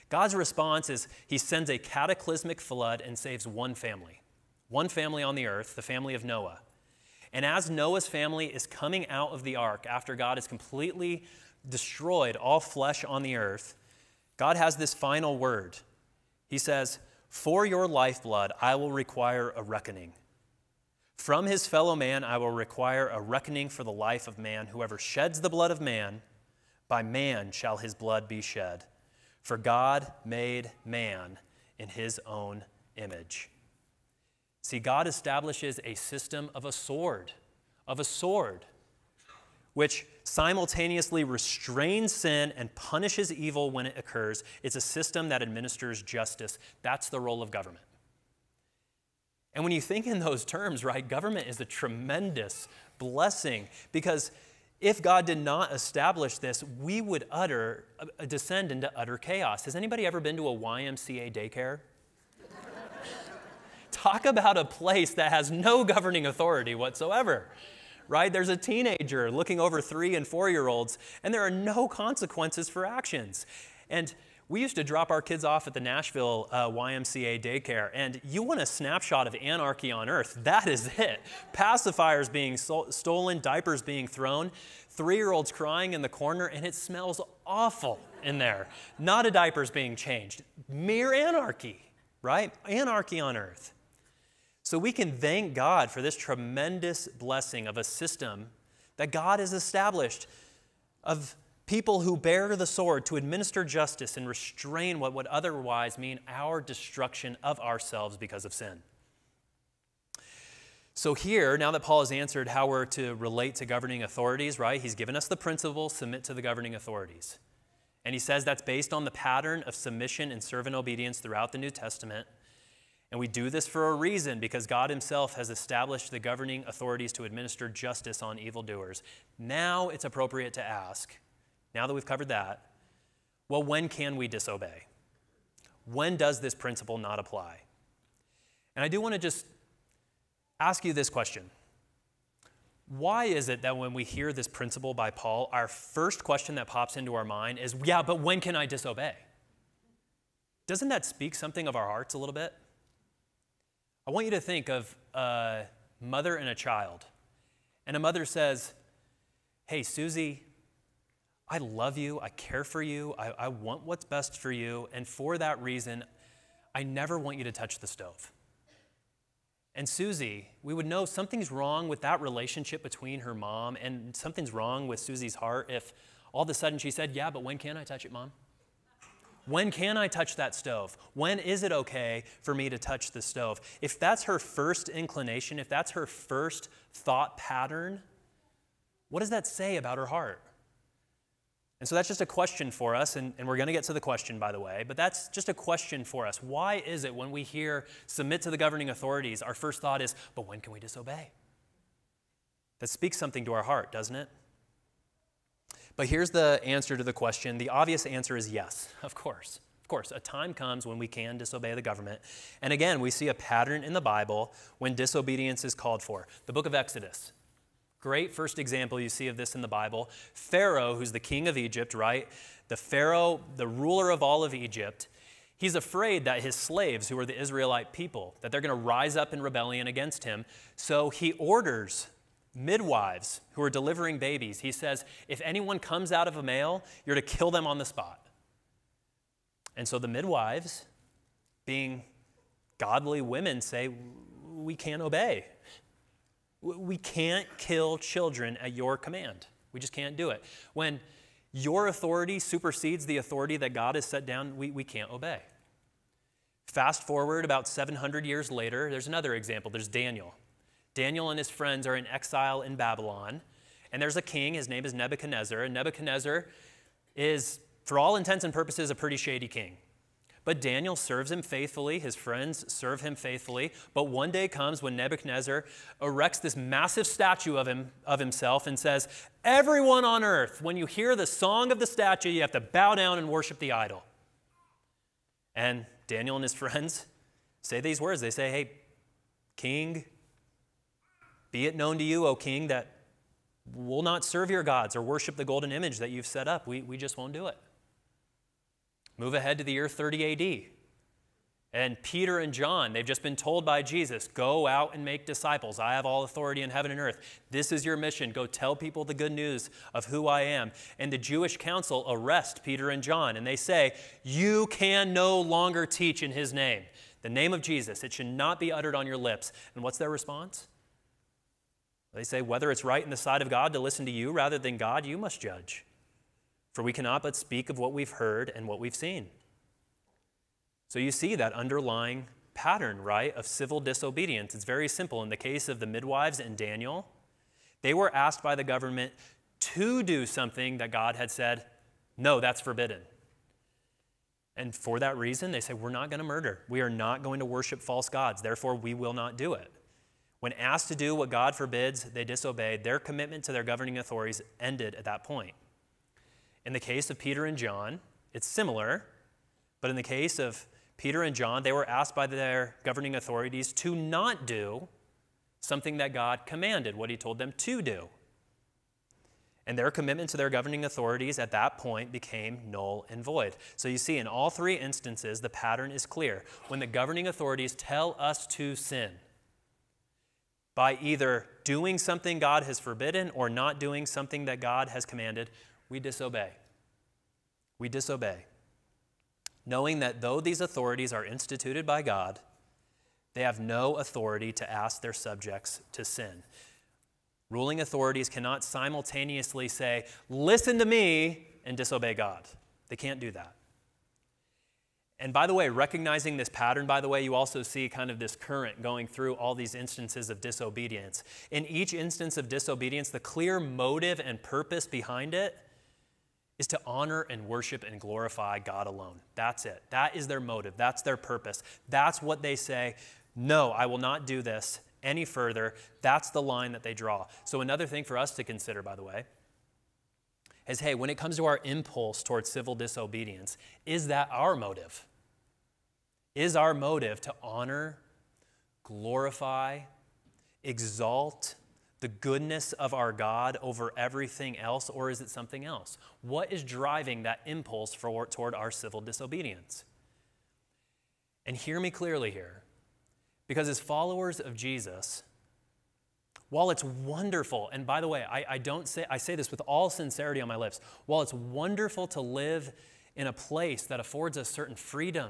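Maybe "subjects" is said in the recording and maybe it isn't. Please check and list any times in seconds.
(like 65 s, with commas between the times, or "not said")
395 s.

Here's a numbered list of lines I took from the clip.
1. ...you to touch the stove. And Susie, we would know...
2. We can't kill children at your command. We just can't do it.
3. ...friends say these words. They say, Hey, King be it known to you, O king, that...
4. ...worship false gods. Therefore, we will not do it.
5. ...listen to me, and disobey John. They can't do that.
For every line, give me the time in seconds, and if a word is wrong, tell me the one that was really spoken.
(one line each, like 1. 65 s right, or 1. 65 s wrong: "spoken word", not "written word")
1. 167 s right
2. 246 s right
3. 286 s right
4. 347 s right
5. 400 s wrong: "God", not "John".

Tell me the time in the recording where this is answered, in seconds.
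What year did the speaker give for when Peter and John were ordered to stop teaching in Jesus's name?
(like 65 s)
299 s.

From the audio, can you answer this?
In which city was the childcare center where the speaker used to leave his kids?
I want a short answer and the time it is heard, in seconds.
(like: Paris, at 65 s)
Nashville, at 75 s.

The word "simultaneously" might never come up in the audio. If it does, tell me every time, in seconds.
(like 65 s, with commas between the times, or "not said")
40 s, 398 s.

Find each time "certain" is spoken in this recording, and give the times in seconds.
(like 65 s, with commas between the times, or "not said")
464 s.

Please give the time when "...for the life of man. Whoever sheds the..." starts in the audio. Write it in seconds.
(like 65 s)
23 s.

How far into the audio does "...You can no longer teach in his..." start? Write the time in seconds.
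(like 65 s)
314 s.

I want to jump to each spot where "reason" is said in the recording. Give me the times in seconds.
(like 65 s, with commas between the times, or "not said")
123 s, 165 s, 345 s.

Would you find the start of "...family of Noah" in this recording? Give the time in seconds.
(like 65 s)
5 s.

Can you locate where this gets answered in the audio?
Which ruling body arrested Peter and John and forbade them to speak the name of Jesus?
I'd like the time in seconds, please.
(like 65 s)
311 s.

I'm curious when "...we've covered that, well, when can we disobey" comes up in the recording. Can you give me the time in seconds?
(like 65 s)
131 s.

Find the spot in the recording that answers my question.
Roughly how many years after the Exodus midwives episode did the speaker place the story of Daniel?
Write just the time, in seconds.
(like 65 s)
257 s.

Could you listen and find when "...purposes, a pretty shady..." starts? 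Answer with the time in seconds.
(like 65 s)
268 s.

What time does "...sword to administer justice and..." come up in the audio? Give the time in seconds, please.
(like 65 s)
102 s.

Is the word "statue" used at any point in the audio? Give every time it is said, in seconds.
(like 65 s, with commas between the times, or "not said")
277 s, 281 s.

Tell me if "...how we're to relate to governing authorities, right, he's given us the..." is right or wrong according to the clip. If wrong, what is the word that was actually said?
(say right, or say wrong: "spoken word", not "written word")
right.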